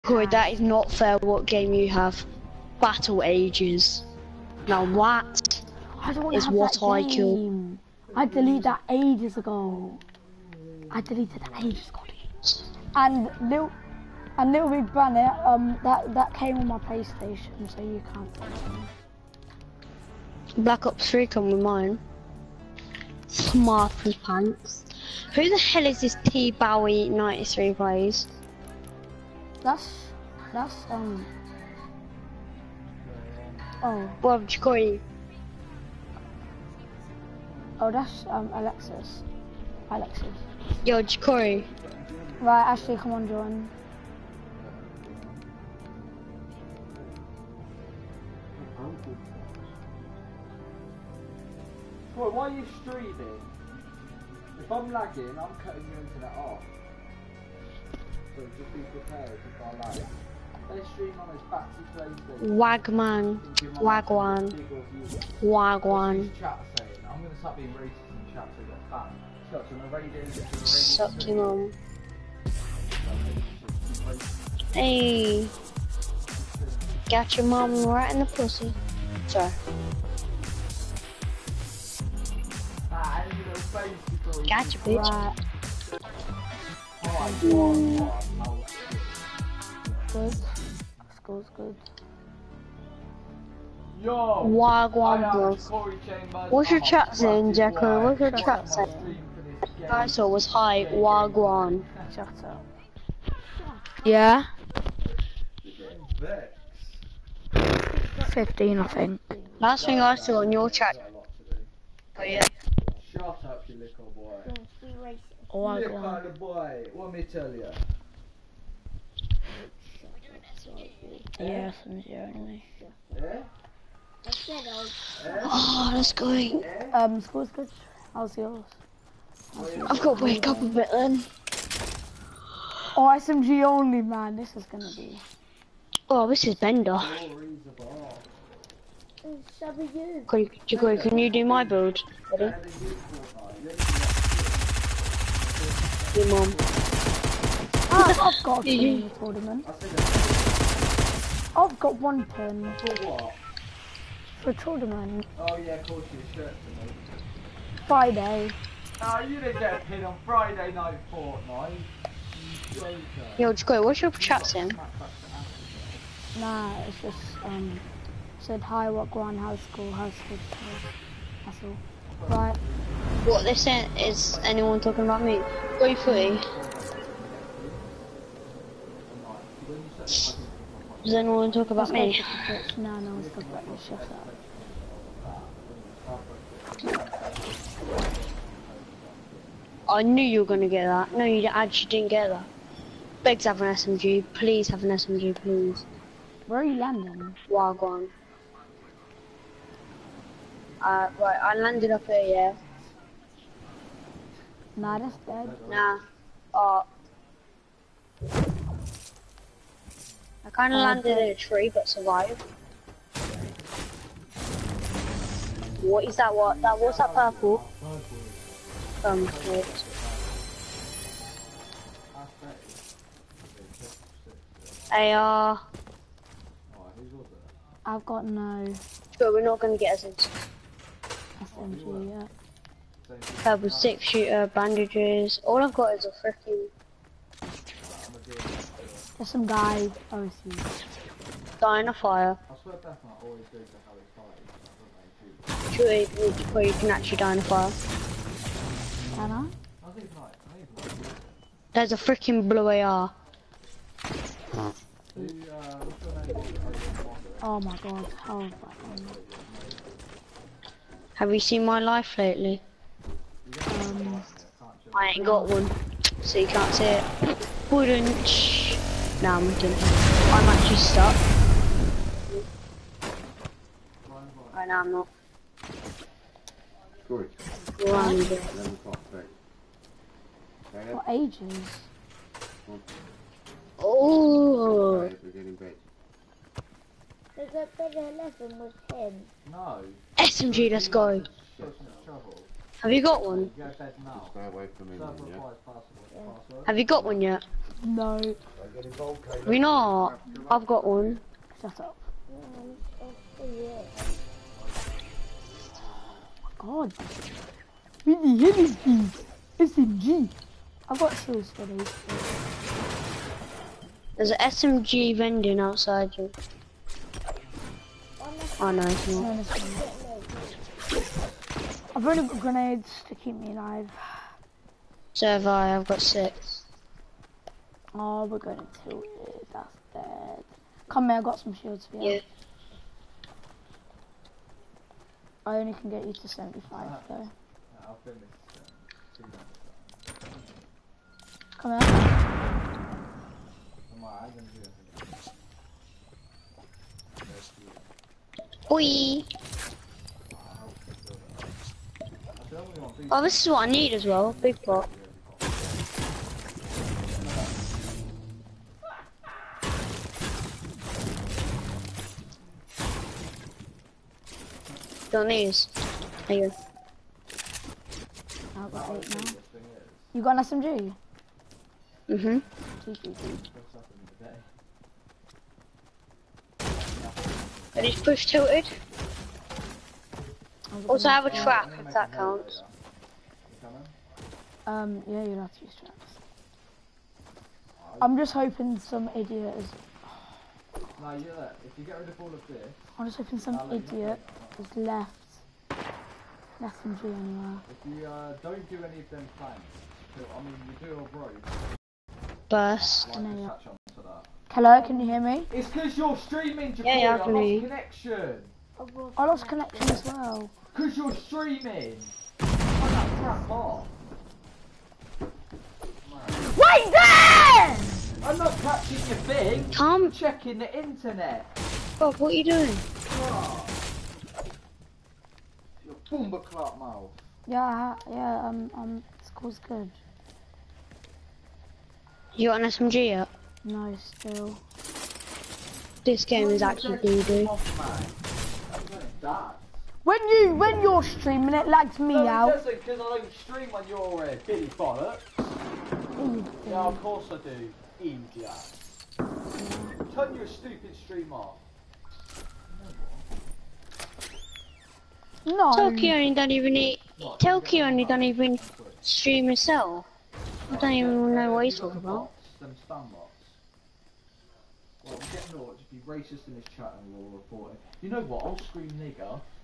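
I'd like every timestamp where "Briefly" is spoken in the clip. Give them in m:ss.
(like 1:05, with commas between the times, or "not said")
2:55.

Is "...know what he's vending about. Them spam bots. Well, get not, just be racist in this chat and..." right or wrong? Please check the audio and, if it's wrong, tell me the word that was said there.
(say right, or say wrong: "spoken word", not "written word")
wrong: "talking", not "vending".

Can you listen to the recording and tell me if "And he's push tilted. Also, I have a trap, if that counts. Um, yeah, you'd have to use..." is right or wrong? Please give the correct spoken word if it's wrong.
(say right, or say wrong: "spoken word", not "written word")
right.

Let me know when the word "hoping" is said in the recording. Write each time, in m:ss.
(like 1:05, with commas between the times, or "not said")
6:28, 6:33.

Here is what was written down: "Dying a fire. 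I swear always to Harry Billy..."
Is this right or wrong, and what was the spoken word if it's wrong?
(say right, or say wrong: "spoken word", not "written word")
wrong: "True", not "Billy".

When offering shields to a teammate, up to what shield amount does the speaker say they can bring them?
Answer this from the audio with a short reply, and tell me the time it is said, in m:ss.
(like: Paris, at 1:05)
75, at 5:36.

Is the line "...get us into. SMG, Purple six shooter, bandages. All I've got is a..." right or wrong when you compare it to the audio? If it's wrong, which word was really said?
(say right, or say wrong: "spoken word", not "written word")
right.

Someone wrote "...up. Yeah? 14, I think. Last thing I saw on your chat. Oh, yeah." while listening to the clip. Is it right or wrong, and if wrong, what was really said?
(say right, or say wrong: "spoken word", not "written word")
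wrong: "15", not "14".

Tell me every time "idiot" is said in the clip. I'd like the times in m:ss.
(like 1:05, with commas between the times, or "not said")
6:29, 6:33.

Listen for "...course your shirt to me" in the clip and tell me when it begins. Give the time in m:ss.
2:35.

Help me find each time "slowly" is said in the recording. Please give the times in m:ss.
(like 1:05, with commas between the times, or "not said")
not said.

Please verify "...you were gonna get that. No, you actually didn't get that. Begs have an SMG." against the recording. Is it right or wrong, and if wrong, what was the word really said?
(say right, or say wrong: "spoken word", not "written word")
right.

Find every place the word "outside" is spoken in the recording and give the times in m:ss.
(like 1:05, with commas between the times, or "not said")
5:15.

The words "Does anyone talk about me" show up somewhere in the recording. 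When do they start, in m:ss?
2:59.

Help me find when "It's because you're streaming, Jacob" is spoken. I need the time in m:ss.
6:45.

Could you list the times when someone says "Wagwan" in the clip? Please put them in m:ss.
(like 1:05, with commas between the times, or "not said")
1:34, 1:40, 3:17.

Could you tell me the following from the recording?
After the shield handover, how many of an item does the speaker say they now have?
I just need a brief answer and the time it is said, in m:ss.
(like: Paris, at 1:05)
8, at 6:08.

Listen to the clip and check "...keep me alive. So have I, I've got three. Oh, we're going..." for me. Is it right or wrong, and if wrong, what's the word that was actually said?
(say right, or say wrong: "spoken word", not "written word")
wrong: "six", not "three".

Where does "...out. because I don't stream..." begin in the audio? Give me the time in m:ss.
7:22.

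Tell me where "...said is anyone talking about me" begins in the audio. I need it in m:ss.
2:53.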